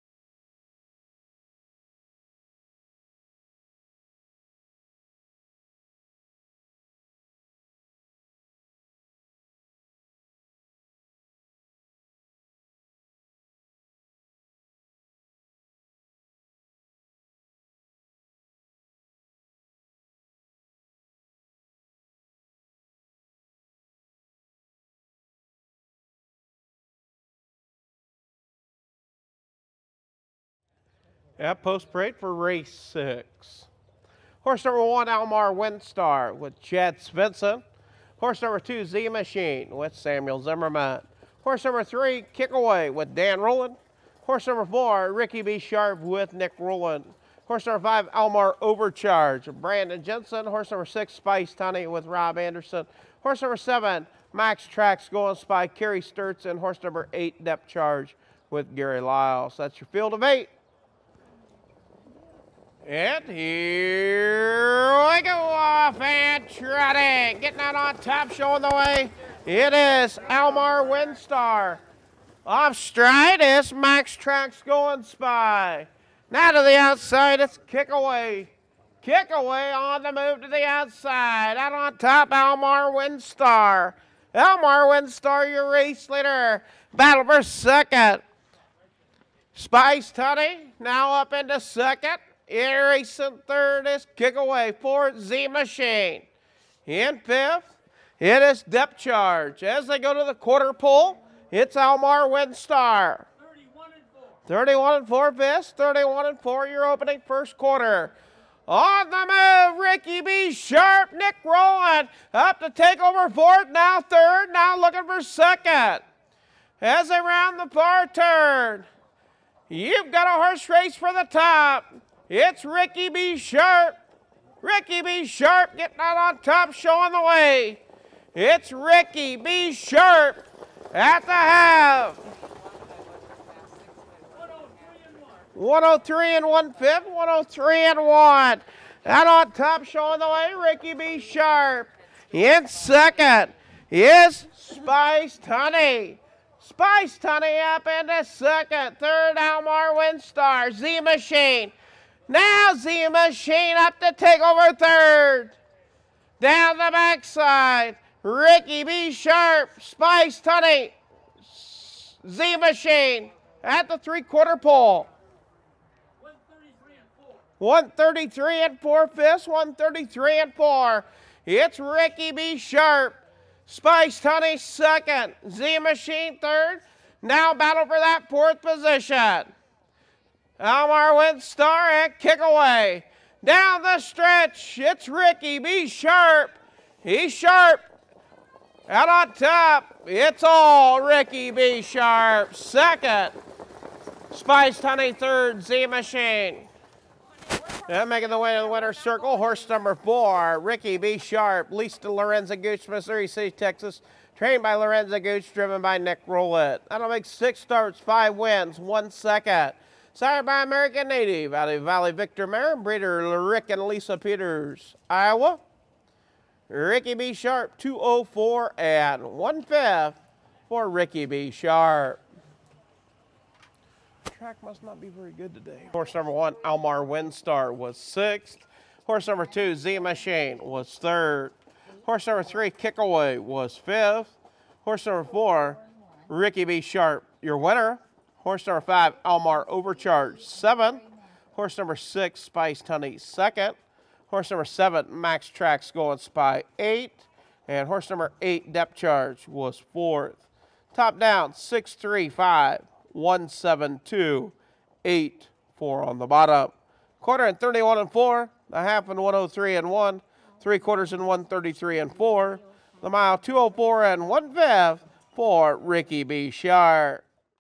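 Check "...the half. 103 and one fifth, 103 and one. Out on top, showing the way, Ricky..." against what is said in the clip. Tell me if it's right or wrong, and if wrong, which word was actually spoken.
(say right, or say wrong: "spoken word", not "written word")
right.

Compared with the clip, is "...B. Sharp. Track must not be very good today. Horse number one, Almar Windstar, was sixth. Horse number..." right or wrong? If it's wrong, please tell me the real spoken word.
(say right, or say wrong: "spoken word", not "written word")
right.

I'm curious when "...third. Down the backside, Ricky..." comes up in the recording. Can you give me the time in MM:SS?
02:34.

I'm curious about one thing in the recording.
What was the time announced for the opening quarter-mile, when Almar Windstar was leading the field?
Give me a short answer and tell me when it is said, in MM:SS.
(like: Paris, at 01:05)
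31 4/5, at 01:44.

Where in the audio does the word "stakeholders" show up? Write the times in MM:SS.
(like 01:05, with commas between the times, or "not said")
not said.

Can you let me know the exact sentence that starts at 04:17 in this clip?
Quarter and 31 and four, a half and 103 and one, three quarters and 133 and four.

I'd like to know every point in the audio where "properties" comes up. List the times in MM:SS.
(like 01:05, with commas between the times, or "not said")
not said.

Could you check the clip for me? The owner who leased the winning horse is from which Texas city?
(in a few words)
Missouri City.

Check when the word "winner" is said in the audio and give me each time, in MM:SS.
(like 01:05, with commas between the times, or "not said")
03:18, 03:57.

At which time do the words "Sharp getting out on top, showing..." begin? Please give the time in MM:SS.
02:05.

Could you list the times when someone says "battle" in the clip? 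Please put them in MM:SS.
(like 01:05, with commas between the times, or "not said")
01:26, 02:57.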